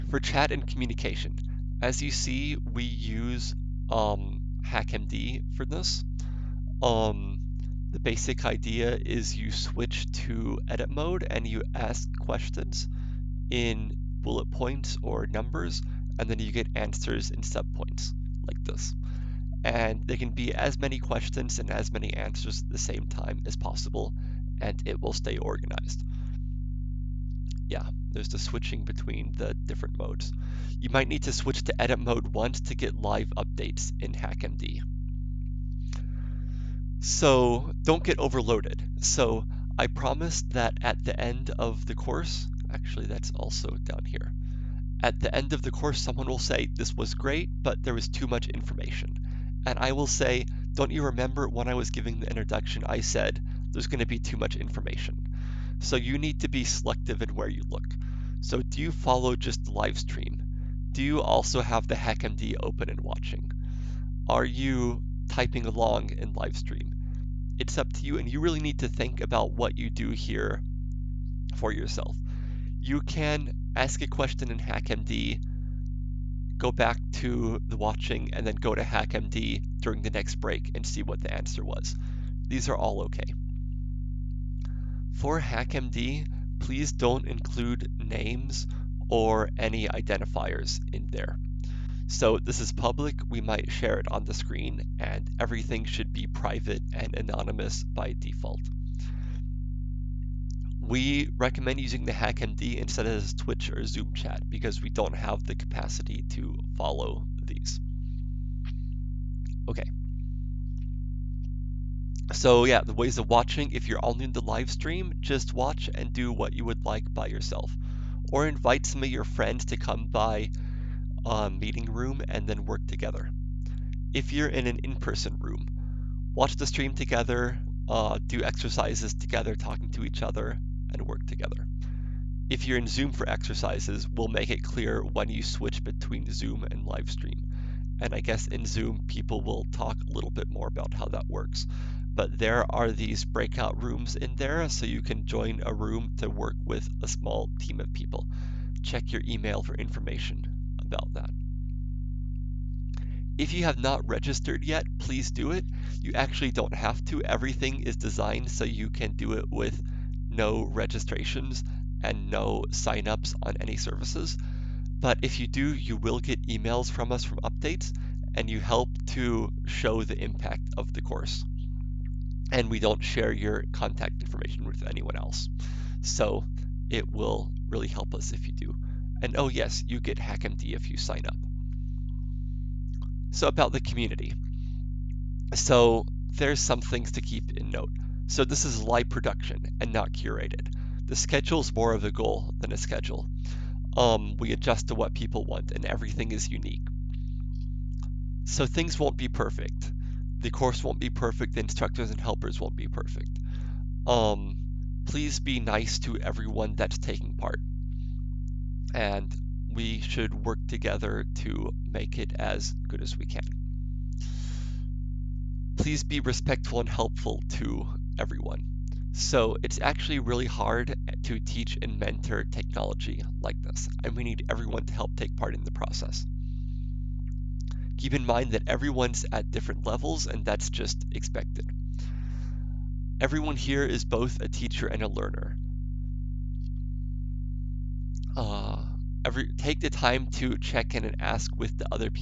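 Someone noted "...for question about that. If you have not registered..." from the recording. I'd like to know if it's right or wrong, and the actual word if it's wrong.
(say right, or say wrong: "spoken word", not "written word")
wrong: "information", not "question".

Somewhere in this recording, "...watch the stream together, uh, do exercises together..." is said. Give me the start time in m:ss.
2:06.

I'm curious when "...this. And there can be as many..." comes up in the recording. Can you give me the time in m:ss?
0:18.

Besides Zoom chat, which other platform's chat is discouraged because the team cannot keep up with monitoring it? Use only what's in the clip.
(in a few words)
Twitch.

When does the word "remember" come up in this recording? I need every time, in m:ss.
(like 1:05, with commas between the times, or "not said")
0:51.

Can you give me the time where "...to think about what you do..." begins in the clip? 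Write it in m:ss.
1:08.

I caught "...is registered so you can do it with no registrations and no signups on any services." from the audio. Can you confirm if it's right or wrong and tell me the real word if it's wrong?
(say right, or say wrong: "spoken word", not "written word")
wrong: "designed", not "registered".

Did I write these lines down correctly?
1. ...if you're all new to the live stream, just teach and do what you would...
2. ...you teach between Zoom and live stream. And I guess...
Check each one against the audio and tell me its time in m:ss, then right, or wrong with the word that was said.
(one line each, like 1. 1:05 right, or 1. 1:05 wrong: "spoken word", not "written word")
1. 1:53 wrong: "watch", not "teach"
2. 2:15 wrong: "switch", not "teach".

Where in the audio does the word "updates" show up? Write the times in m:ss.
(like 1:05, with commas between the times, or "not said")
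0:33, 2:47.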